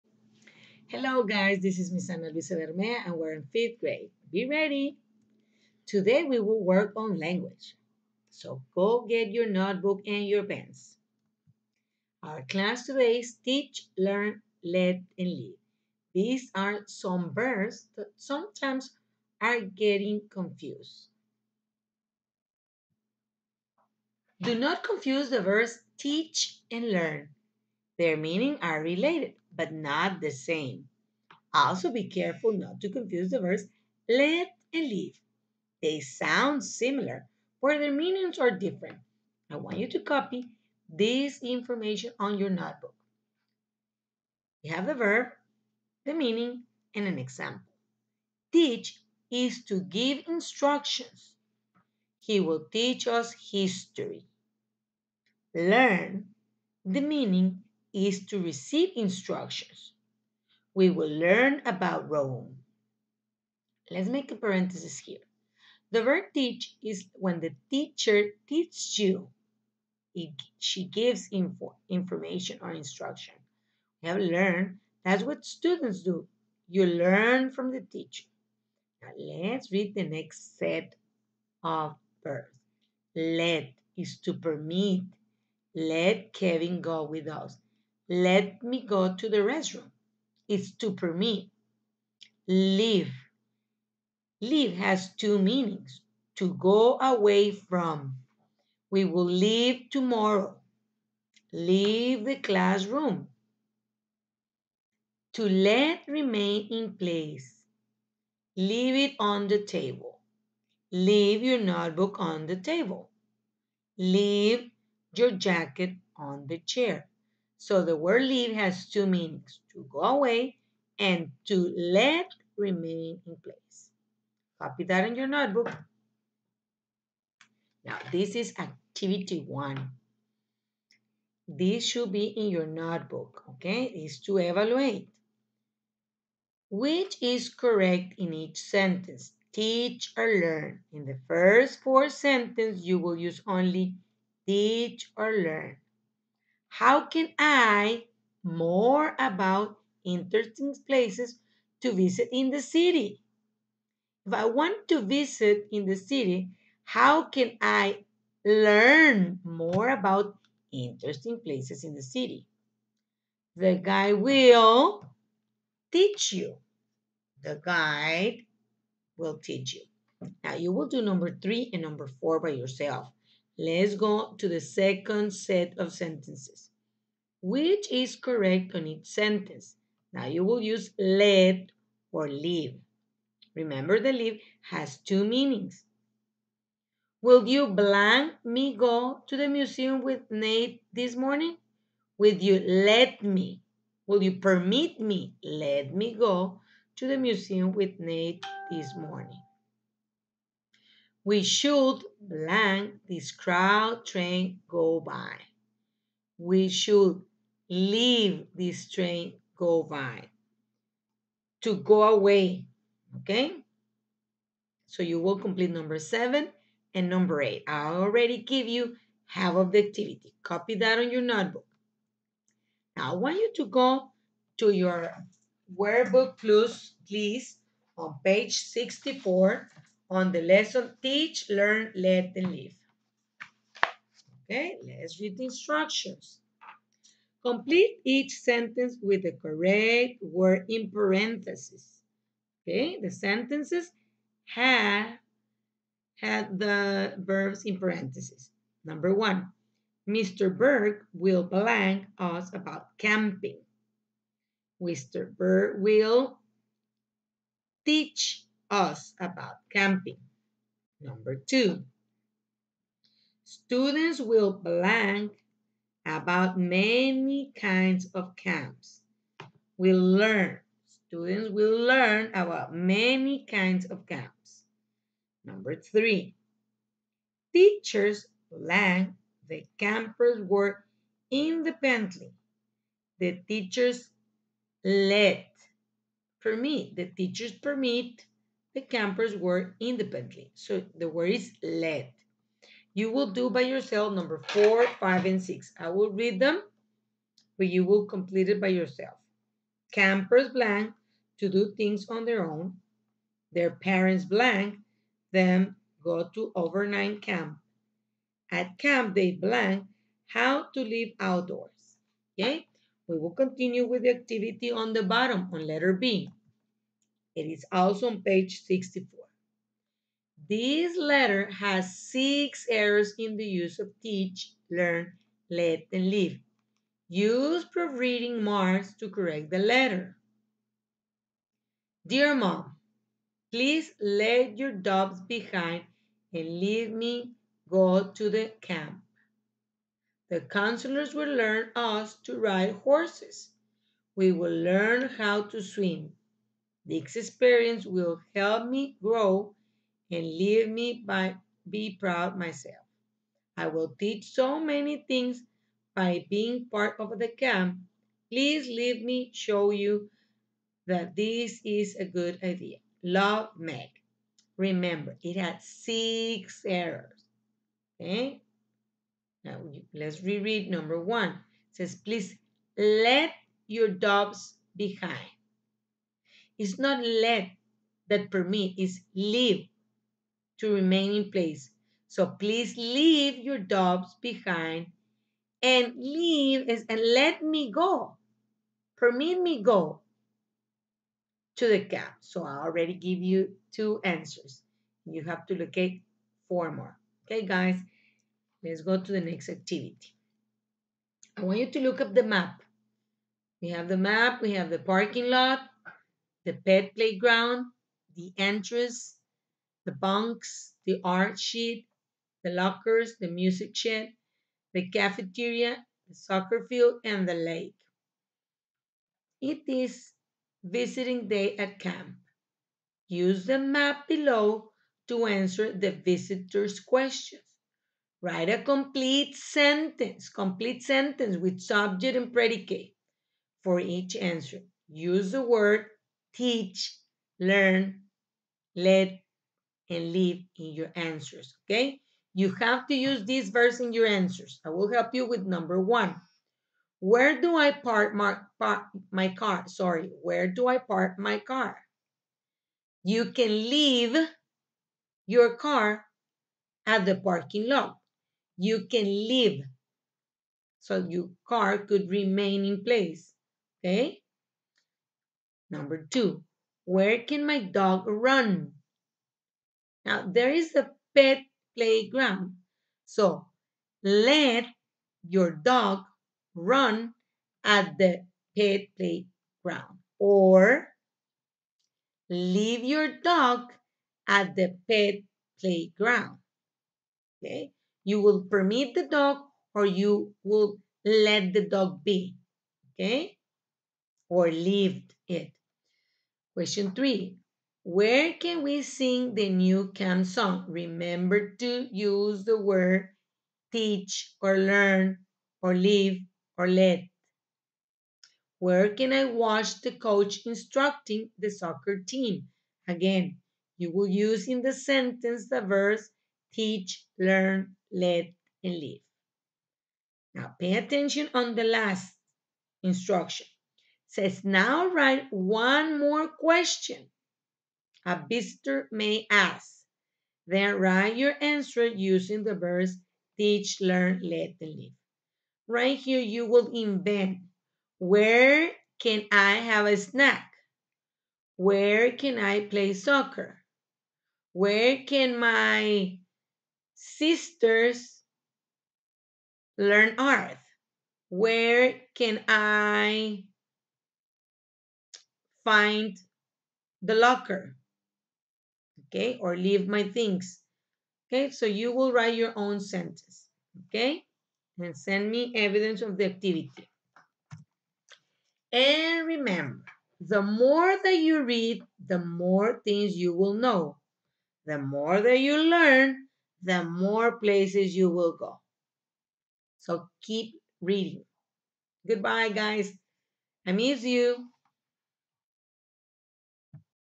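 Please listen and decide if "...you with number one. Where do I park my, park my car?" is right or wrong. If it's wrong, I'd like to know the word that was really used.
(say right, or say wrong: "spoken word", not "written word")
right.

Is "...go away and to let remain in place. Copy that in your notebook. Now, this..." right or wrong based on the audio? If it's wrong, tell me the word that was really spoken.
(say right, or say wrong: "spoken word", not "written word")
right.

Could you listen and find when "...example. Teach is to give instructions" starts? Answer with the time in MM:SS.
00:47.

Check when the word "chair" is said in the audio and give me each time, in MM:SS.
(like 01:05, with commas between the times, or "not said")
01:56.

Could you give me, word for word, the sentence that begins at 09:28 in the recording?
And remember, the more that you read, the more things you will know.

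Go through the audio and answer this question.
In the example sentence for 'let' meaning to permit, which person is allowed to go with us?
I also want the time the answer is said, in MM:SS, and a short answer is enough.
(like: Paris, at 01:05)
Kevin, at 01:26.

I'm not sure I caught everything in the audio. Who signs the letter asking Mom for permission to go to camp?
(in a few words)
Meg.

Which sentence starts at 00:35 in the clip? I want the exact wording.
They sound similar, but their meanings are different.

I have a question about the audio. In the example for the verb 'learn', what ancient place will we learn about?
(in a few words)
Rome.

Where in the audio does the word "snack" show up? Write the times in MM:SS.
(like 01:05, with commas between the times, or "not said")
08:59.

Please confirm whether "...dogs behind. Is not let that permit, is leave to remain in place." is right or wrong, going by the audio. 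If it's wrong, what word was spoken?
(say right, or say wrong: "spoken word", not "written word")
right.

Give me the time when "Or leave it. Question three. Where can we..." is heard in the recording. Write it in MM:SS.
08:14.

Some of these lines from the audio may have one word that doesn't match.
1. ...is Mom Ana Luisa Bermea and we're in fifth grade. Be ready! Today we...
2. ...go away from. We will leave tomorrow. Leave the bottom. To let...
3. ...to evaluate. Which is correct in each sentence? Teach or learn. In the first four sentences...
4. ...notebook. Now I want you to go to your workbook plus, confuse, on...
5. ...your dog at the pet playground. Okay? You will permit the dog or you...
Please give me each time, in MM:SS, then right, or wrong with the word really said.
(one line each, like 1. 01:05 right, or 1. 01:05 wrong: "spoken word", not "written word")
1. 00:01 wrong: "Miss", not "Mom"
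2. 01:36 wrong: "classroom", not "bottom"
3. 02:14 right
4. 03:41 wrong: "please", not "confuse"
5. 08:02 right.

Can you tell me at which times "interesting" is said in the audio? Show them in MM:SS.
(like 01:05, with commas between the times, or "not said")
02:30, 02:40.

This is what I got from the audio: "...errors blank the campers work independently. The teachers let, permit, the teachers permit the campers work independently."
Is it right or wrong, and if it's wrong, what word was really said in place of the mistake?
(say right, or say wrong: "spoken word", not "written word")
wrong: "teachers", not "errors".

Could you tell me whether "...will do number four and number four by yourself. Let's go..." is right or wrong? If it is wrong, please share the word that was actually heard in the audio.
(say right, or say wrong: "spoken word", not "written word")
wrong: "three", not "four".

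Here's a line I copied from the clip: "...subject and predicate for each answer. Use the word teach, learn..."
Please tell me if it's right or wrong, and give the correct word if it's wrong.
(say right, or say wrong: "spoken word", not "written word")
right.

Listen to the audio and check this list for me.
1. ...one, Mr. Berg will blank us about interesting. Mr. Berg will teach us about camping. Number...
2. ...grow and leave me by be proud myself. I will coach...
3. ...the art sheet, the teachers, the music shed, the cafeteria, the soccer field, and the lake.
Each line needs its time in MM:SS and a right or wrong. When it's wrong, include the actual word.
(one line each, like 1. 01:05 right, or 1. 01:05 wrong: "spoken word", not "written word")
1. 04:09 wrong: "camping", not "interesting"
2. 05:49 wrong: "teach", not "coach"
3. 06:50 wrong: "lockers", not "teachers".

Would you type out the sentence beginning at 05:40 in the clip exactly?
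The counselors will learn us to ride horses.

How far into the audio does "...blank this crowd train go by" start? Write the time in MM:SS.
03:22.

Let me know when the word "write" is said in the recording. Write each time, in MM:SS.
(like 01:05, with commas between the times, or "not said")
07:08, 08:44, 08:50, 09:22.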